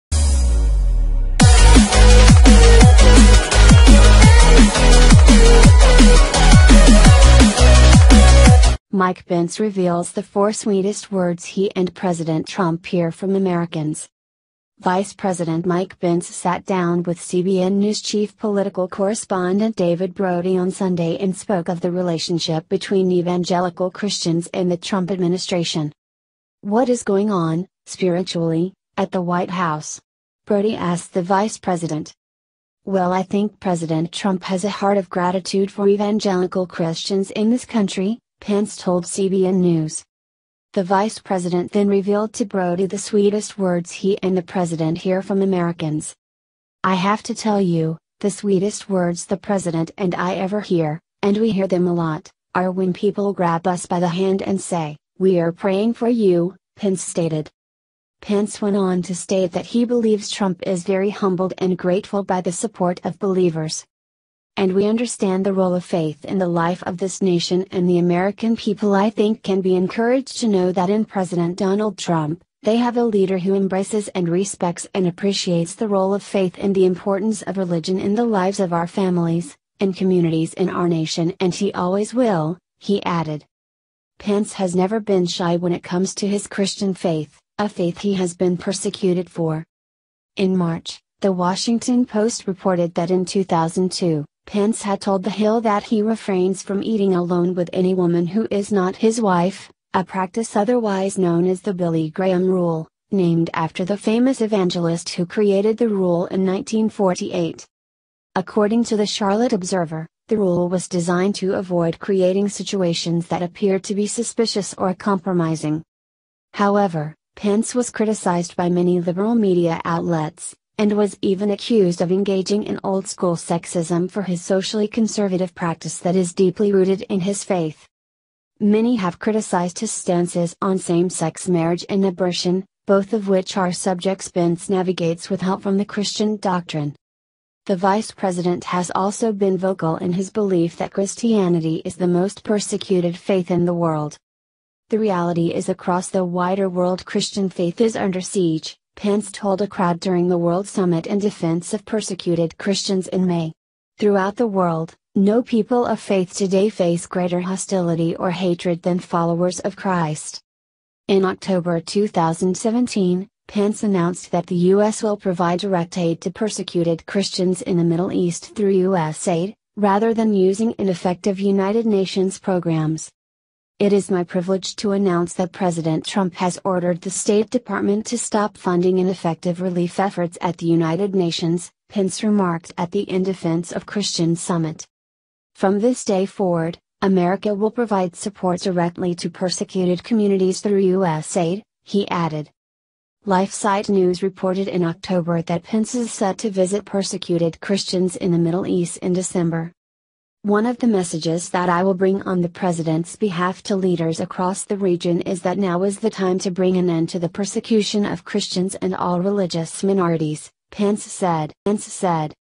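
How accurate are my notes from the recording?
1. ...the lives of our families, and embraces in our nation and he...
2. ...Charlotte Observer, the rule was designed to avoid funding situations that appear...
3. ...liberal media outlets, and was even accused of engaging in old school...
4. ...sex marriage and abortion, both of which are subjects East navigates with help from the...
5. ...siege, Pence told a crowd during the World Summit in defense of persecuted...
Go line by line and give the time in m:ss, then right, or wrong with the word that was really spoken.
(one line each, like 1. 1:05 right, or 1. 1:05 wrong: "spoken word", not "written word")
1. 1:18 wrong: "communities", not "embraces"
2. 1:49 wrong: "creating", not "funding"
3. 1:58 right
4. 2:11 wrong: "Pence", not "East"
5. 2:28 right.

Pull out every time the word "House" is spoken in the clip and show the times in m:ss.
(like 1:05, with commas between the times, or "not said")
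0:29.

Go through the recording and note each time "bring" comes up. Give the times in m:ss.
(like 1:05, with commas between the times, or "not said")
3:21, 3:26.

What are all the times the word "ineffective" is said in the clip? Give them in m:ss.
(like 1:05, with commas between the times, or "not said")
2:50, 2:58.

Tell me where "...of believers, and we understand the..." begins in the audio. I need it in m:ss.
1:03.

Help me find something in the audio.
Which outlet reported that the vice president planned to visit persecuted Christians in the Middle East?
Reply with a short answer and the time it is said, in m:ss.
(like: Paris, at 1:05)
LifeSite News, at 3:13.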